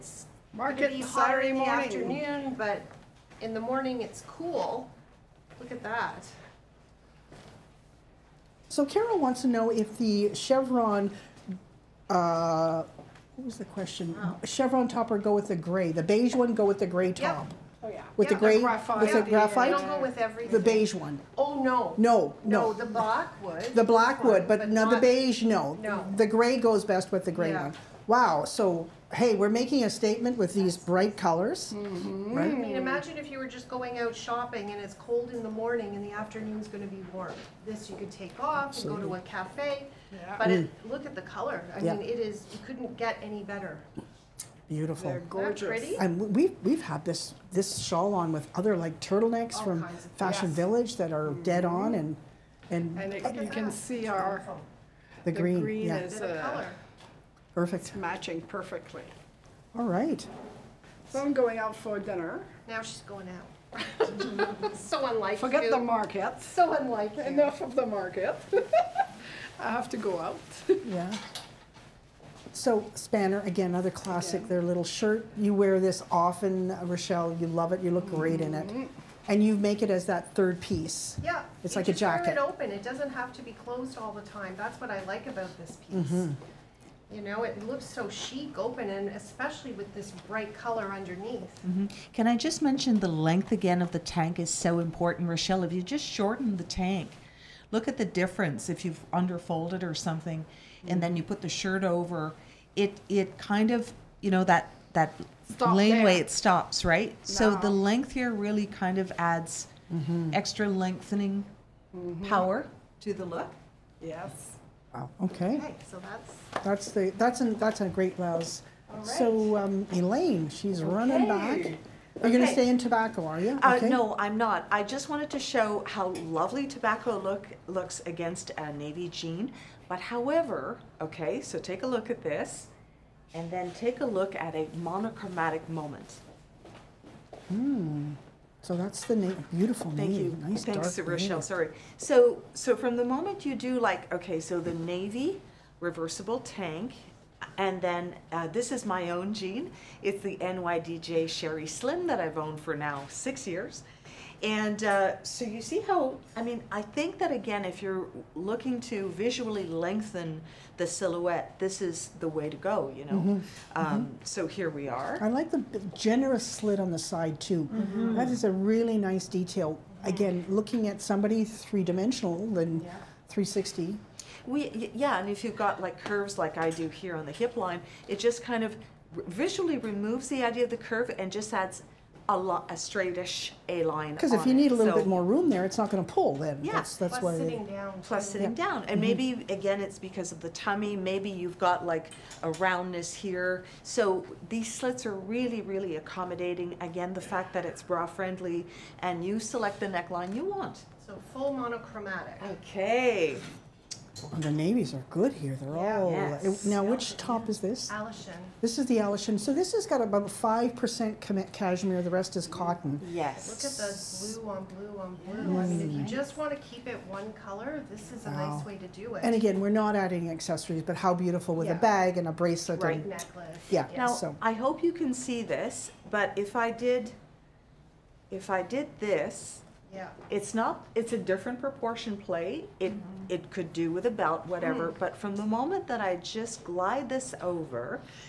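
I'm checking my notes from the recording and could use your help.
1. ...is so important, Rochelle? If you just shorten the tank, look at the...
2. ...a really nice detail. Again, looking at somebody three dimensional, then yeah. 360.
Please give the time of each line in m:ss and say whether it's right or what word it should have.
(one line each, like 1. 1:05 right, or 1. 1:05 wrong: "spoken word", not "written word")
1. 1:34 right
2. 2:48 right.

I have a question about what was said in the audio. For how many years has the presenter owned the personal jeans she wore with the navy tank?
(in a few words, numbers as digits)
6.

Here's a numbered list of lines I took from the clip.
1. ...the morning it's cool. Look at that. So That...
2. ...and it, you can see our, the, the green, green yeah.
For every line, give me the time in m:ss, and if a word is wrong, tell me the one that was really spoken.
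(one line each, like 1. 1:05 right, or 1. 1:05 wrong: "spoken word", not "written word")
1. 0:03 wrong: "Carol", not "That"
2. 0:52 right.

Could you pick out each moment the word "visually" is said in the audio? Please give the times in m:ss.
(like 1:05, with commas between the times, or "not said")
2:39, 2:59.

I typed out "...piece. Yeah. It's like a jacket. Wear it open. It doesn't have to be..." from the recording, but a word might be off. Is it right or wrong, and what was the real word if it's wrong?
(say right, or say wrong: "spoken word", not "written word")
right.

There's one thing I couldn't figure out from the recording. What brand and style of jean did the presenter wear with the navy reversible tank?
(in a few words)
NYDJ Sheri Slim.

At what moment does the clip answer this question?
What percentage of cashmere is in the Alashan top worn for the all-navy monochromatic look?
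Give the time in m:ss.
3:30.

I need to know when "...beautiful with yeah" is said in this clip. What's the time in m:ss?
3:41.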